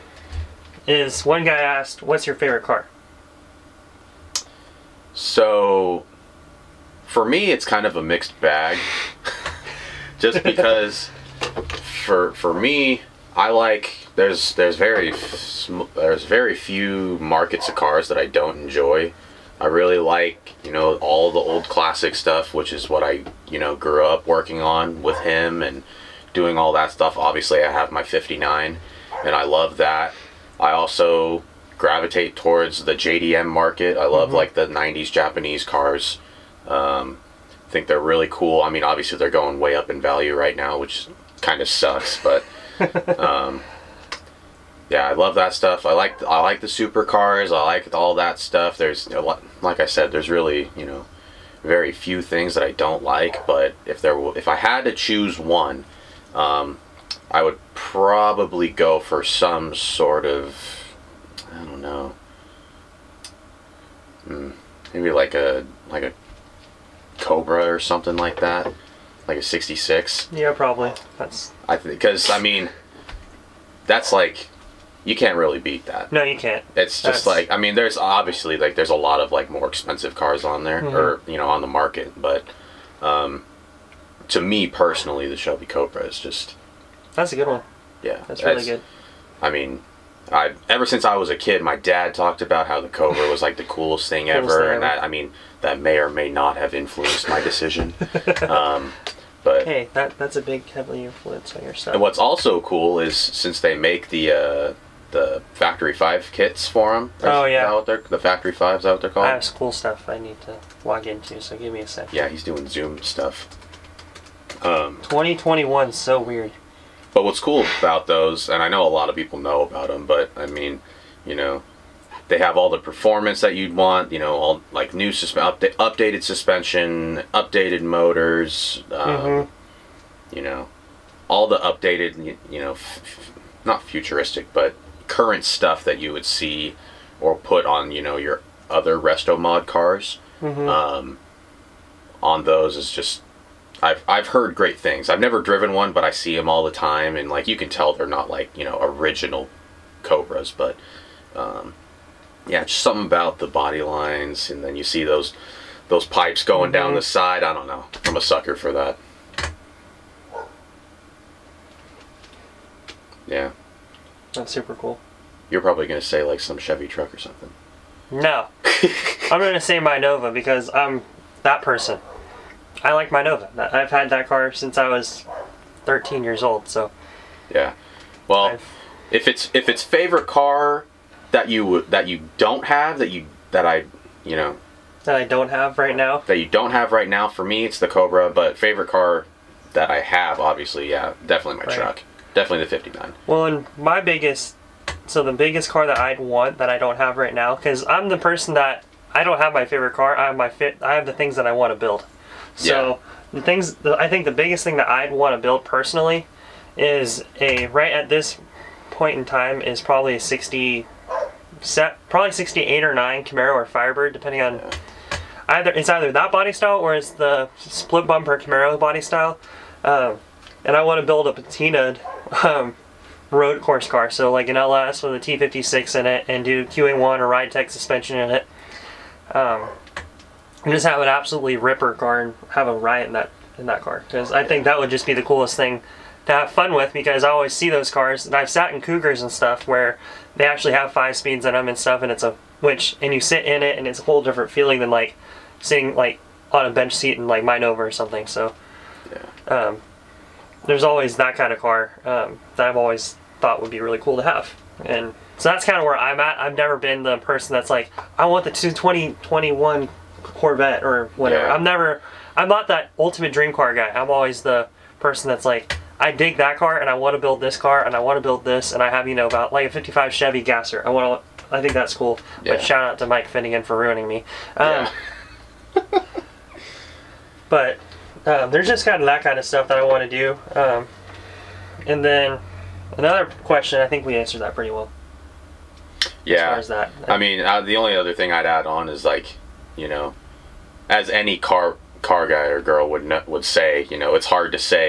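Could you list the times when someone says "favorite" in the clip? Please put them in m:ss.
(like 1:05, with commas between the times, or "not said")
0:02, 2:59, 3:08, 3:19.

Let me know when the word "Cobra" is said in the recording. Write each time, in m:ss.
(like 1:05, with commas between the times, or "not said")
1:07, 1:25, 1:32, 2:30, 3:07.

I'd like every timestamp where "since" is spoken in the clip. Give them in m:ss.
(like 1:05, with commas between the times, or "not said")
1:30, 1:43, 2:54.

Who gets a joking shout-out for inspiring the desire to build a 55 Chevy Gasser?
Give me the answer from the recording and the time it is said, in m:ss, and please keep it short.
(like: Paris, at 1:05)
Mike Finnegan, at 4:33.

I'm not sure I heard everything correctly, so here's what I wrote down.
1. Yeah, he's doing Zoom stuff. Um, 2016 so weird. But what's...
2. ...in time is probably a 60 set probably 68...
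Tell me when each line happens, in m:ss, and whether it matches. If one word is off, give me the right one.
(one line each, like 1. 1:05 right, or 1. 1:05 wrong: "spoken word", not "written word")
1. 1:52 wrong: "2021", not "2016"
2. 3:29 right.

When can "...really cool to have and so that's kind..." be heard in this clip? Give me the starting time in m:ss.
4:13.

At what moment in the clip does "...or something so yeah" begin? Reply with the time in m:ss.
4:07.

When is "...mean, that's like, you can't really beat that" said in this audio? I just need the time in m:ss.
1:12.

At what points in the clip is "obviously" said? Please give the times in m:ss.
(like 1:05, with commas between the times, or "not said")
0:27, 0:38, 1:17, 3:10.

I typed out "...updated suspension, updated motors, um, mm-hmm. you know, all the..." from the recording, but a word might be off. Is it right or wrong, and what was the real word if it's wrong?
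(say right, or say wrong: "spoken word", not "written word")
right.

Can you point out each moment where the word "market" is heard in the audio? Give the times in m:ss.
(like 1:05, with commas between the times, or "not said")
0:17, 0:33, 1:21.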